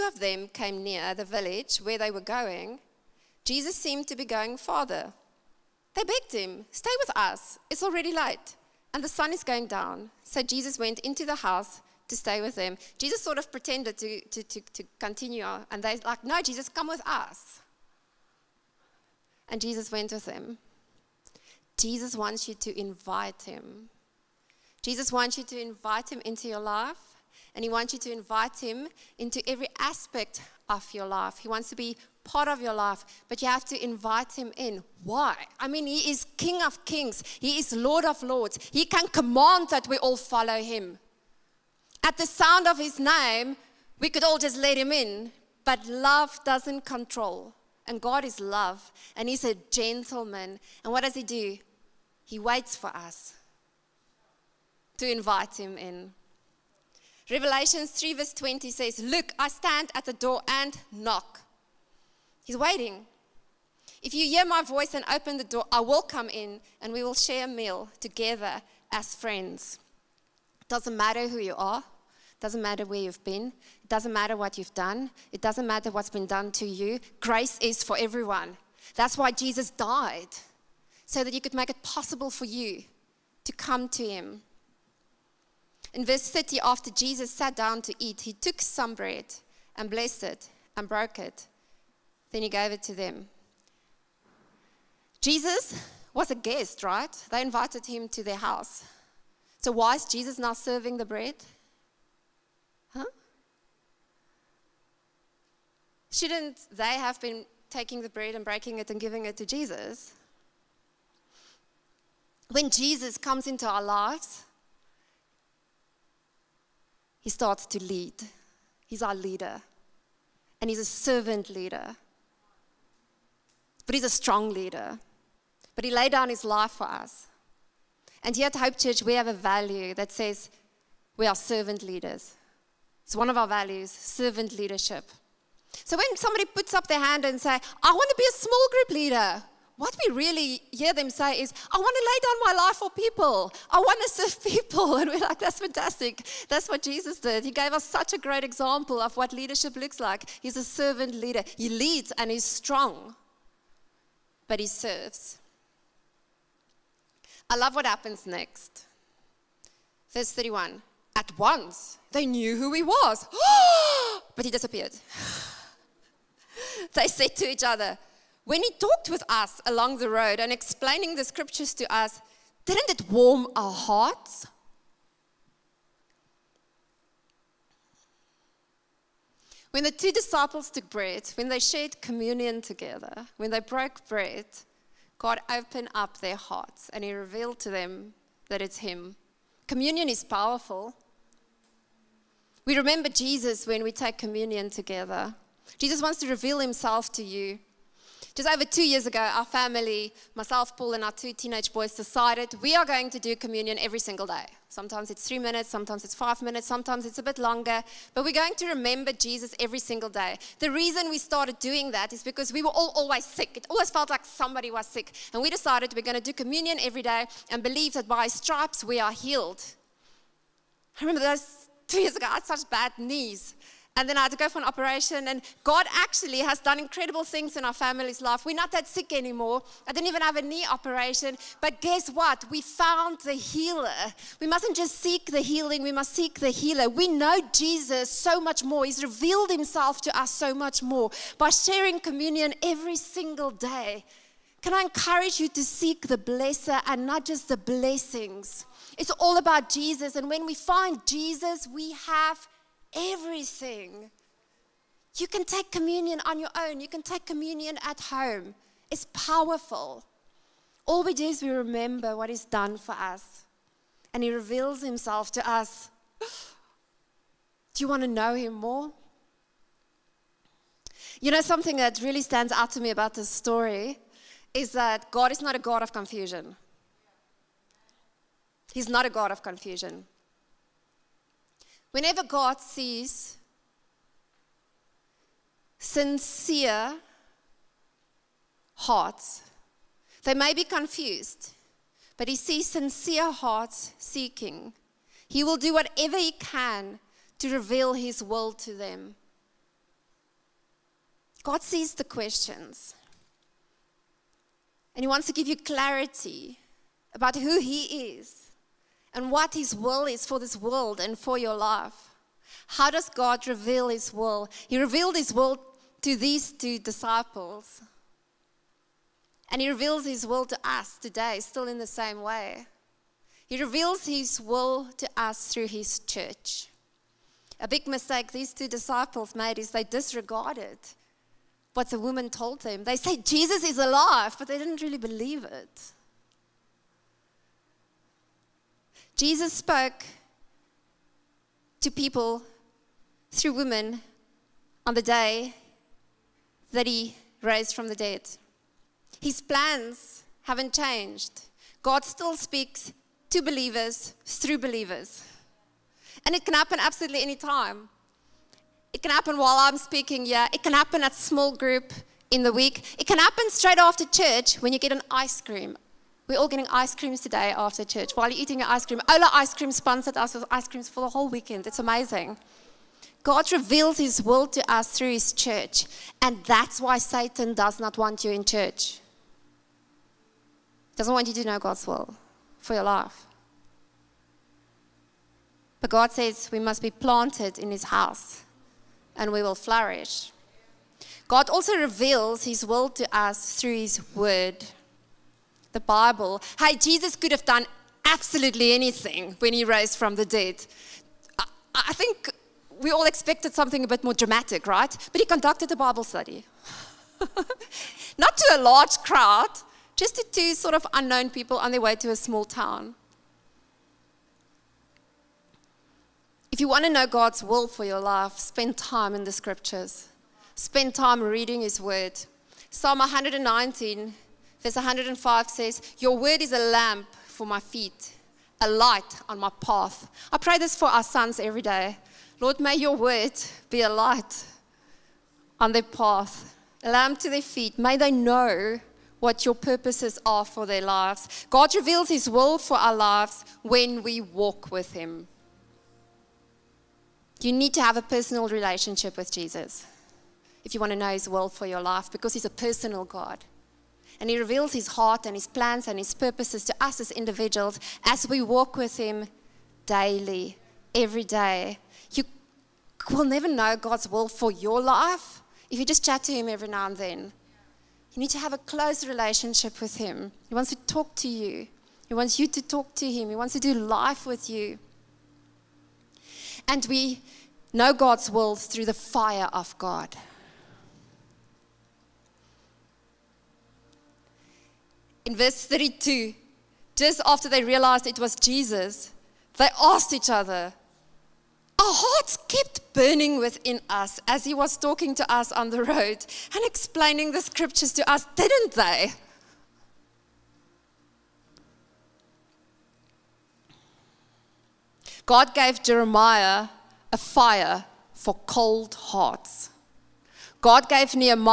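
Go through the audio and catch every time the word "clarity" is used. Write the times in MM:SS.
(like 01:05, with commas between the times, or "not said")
05:05.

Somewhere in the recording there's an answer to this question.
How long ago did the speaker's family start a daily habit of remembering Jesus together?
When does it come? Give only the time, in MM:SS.
03:18.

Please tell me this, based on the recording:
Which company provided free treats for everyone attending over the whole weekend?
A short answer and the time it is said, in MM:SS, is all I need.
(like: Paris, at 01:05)
Ola Ice Cream, at 06:09.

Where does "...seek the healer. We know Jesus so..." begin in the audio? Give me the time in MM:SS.
03:56.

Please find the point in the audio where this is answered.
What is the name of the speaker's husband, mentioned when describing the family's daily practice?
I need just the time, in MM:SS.
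03:20.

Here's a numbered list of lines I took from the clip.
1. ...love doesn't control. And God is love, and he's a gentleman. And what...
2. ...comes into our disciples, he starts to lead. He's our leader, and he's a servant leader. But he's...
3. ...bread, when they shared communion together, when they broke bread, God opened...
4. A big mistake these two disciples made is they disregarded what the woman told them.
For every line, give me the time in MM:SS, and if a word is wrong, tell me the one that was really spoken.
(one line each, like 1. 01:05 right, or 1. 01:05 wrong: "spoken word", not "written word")
1. 00:45 right
2. 01:53 wrong: "lives", not "disciples"
3. 03:00 right
4. 05:27 right.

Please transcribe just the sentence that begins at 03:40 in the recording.
I remember those two years ago, I had such bad knees and then I had to go for an operation.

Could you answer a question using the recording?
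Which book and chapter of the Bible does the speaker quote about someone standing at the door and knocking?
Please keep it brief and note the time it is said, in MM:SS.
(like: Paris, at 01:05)
Revelations 3, at 00:57.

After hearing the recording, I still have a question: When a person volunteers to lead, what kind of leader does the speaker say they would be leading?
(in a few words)
Small group leader.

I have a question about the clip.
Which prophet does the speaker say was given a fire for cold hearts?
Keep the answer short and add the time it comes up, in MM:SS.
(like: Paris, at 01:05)
Jeremiah, at 08:25.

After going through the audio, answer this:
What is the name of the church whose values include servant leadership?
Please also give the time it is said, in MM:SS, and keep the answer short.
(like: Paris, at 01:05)
Hope Church, at 02:08.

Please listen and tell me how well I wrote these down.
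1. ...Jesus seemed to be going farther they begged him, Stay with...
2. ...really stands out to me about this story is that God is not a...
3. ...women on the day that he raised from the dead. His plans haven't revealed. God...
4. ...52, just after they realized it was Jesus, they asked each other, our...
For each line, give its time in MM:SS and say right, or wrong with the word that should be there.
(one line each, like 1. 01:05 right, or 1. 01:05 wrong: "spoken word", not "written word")
1. 00:03 right
2. 04:32 right
3. 05:43 wrong: "changed", not "revealed"
4. 08:05 wrong: "32", not "52".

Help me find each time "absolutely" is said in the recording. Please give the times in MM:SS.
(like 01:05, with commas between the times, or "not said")
05:56, 06:38.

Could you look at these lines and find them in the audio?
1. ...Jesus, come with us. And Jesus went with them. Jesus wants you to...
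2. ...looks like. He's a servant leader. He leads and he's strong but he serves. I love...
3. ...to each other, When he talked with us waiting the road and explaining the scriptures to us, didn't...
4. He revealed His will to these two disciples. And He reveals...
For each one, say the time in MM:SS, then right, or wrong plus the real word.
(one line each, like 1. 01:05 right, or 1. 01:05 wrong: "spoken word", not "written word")
1. 00:16 right
2. 02:29 right
3. 02:47 wrong: "along", not "waiting"
4. 05:14 right.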